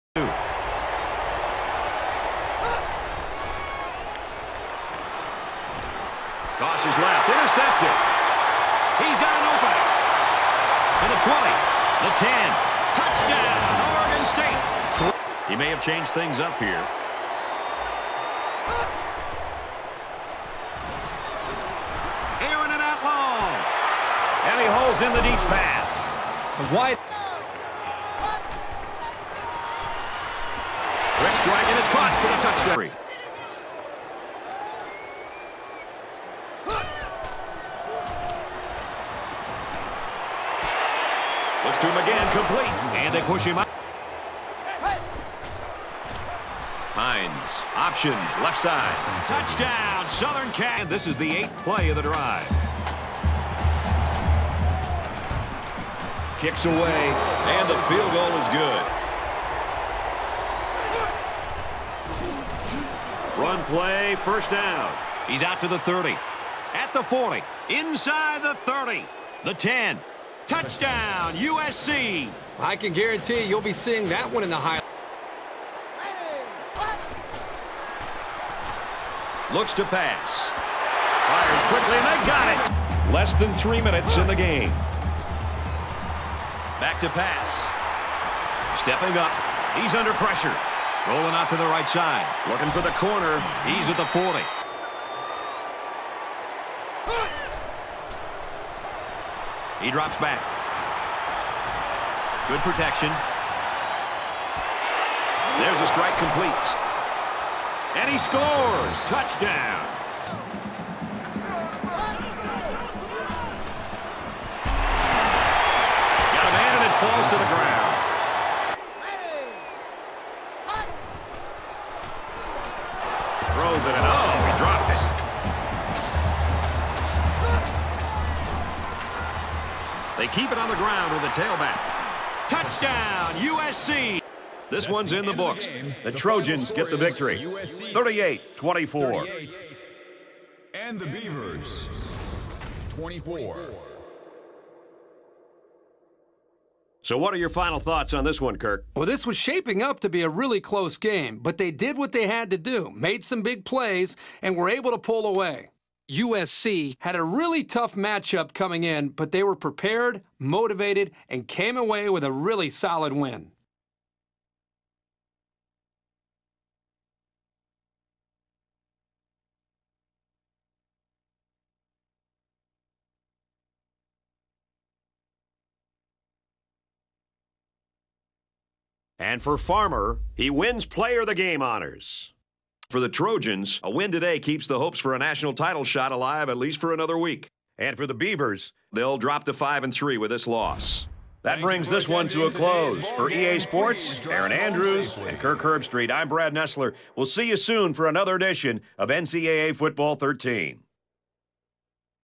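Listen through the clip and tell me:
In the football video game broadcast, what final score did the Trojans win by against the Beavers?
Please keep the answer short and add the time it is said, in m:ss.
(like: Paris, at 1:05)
38-24, at 2:17.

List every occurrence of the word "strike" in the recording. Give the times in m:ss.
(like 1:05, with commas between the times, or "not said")
0:31, 1:45.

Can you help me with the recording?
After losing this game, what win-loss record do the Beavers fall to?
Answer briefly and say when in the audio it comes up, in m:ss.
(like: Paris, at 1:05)
5 and 3, at 3:09.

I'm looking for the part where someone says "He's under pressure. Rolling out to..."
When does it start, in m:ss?
1:29.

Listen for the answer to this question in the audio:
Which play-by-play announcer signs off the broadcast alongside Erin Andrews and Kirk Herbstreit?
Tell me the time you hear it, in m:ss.
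3:16.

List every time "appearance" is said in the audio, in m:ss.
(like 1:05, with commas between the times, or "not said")
not said.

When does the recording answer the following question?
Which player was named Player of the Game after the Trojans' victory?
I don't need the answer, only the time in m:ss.
2:59.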